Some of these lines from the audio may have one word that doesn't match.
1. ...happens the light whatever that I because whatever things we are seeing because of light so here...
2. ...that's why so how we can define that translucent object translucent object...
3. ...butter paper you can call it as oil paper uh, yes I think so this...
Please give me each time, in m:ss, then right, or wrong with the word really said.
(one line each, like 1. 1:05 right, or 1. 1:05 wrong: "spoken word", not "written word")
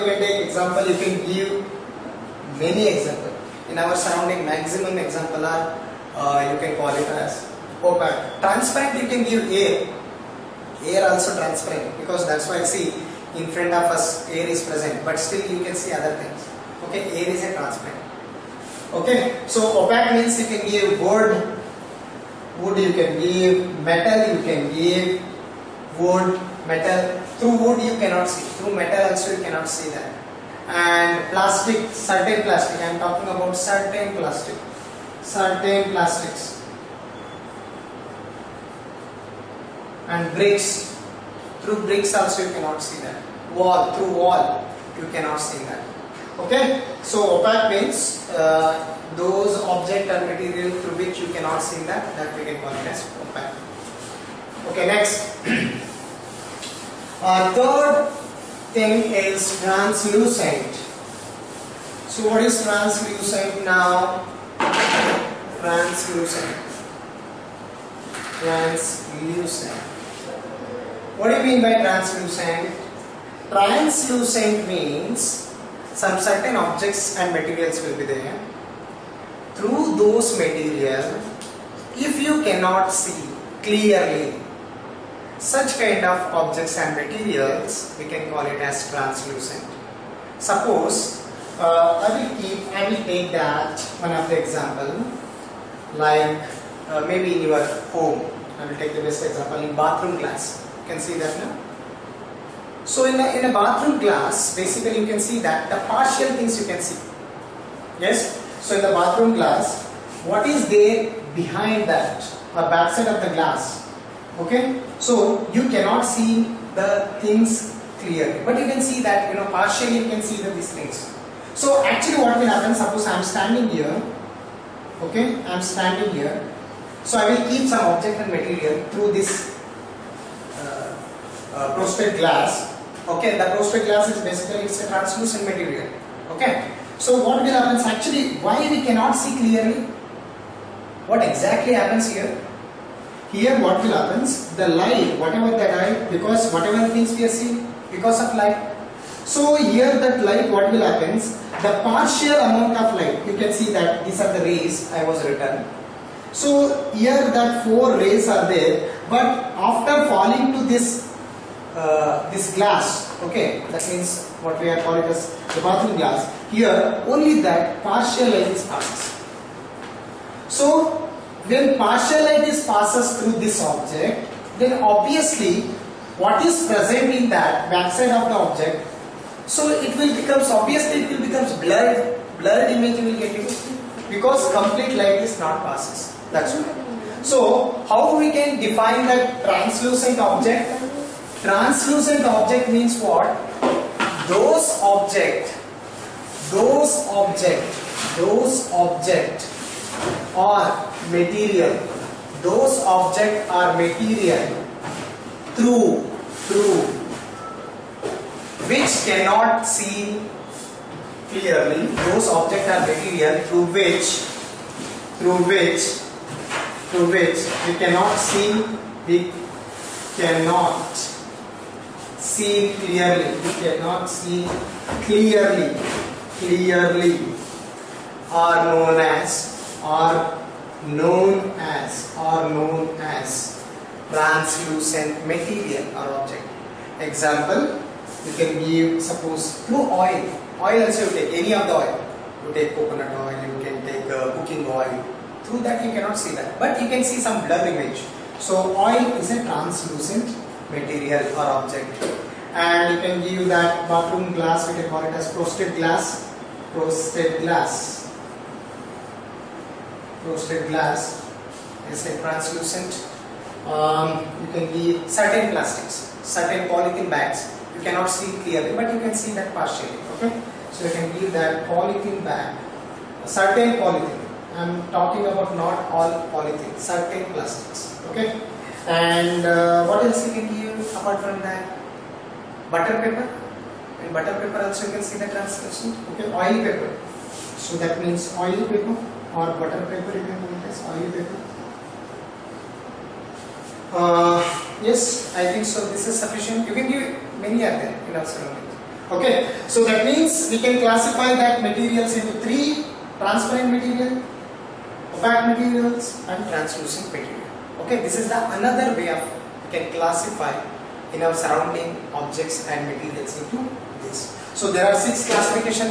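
1. 2:23 right
2. 3:06 right
3. 4:49 right.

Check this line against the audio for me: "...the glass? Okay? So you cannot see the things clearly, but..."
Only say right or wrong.
right.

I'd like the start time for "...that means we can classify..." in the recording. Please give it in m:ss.
4:59.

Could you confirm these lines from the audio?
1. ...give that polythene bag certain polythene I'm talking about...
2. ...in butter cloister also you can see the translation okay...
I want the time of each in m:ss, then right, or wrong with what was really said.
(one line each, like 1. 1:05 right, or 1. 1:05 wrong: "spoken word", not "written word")
1. 4:31 right
2. 4:44 wrong: "paper", not "cloister".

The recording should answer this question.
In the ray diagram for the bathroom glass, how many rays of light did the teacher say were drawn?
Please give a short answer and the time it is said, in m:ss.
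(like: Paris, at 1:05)
4, at 2:37.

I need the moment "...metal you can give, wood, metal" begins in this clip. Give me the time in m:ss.
0:23.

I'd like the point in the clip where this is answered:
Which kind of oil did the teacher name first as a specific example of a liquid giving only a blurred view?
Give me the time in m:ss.
4:02.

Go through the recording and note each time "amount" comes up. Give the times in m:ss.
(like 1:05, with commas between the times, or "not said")
2:32.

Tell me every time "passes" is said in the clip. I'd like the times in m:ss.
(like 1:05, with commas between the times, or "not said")
2:48, 2:52, 3:05.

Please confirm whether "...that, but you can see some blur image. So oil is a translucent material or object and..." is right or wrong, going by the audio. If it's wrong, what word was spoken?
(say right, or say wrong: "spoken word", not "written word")
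right.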